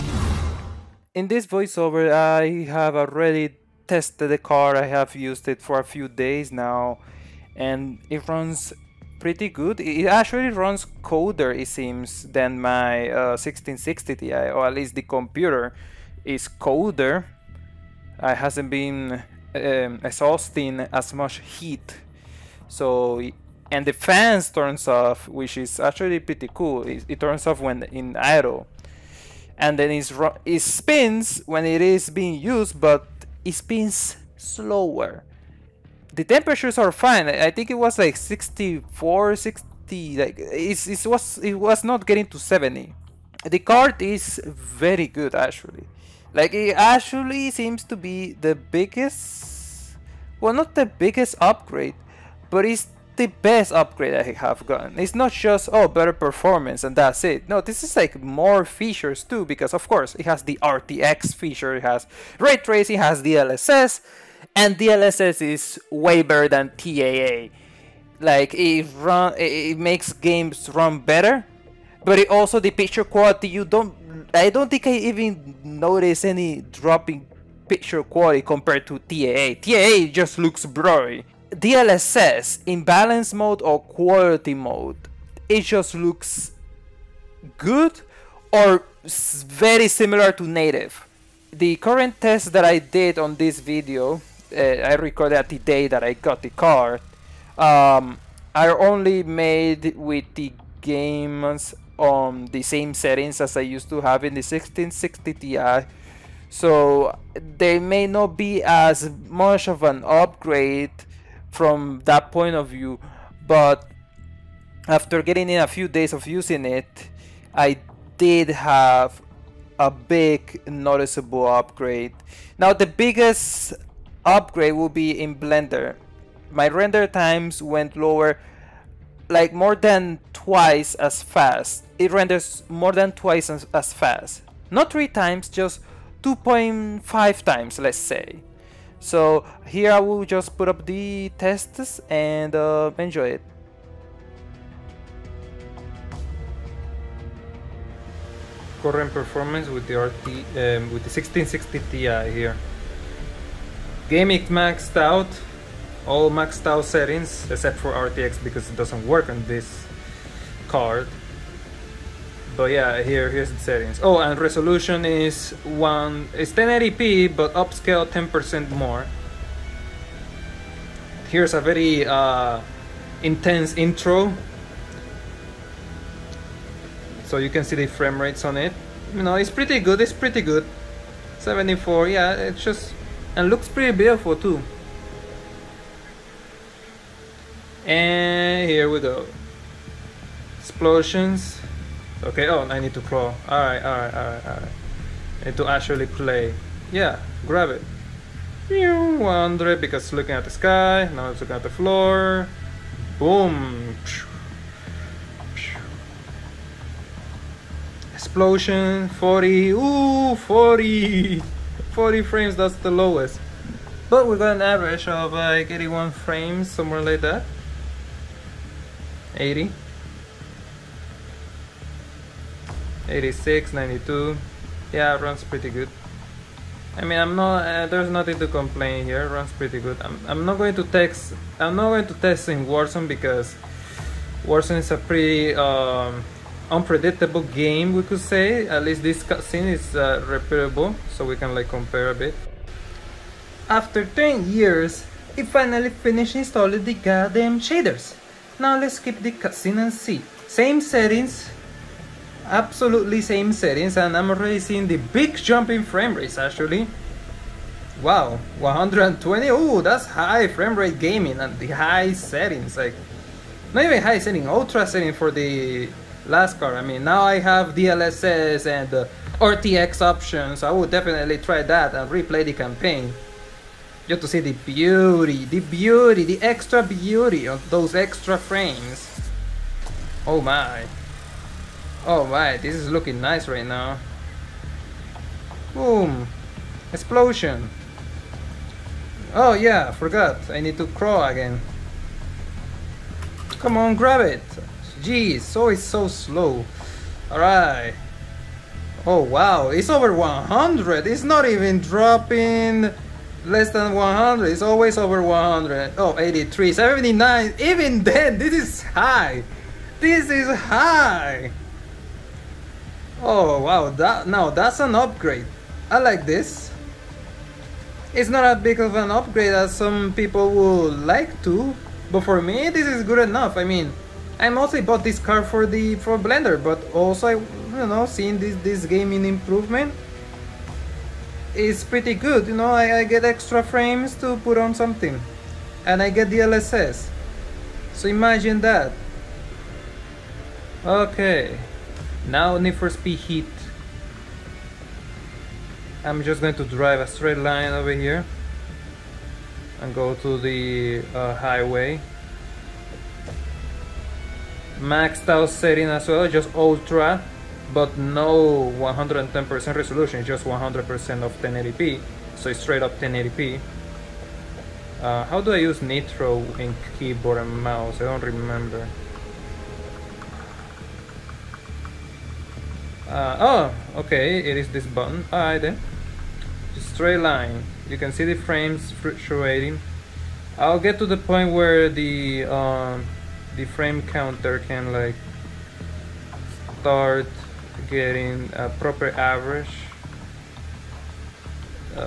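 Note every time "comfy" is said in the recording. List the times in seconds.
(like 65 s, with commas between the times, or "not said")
not said.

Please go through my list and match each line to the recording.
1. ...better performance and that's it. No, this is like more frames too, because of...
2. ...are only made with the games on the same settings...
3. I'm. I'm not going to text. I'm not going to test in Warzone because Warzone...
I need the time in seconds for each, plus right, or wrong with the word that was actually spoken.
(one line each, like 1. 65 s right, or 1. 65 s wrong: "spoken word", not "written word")
1. 55 s wrong: "features", not "frames"
2. 98 s right
3. 229 s right.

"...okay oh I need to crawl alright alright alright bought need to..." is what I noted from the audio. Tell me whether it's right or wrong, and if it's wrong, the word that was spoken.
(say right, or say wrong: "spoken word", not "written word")
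wrong: "alright", not "bought".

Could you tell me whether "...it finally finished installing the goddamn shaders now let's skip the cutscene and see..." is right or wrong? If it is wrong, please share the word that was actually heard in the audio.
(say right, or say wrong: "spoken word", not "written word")
right.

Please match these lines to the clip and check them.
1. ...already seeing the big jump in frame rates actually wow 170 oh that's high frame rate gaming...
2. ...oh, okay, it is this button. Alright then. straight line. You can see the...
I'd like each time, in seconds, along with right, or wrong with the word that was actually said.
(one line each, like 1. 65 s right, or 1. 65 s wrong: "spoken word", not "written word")
1. 254 s wrong: "120", not "170"
2. 373 s right.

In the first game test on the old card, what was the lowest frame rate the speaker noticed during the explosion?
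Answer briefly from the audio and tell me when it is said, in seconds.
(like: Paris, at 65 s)
40, at 211 s.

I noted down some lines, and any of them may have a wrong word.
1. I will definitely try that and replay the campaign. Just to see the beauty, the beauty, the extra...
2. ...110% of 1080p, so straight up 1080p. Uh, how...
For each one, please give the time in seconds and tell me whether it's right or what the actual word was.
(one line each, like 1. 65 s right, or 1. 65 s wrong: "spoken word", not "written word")
1. 270 s right
2. 360 s wrong: "100", not "110".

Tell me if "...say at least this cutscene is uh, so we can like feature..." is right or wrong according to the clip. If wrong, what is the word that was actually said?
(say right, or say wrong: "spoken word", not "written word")
wrong: "compare", not "feature".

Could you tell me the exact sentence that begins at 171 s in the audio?
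Here's a very uh, intense intro, so you can see the frame rates on it.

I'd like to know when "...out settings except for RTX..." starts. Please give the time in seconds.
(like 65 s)
156 s.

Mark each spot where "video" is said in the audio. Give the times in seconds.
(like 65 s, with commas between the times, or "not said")
93 s.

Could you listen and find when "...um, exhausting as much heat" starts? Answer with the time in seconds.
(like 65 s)
19 s.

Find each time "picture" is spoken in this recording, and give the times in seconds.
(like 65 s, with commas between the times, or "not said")
72 s, 77 s.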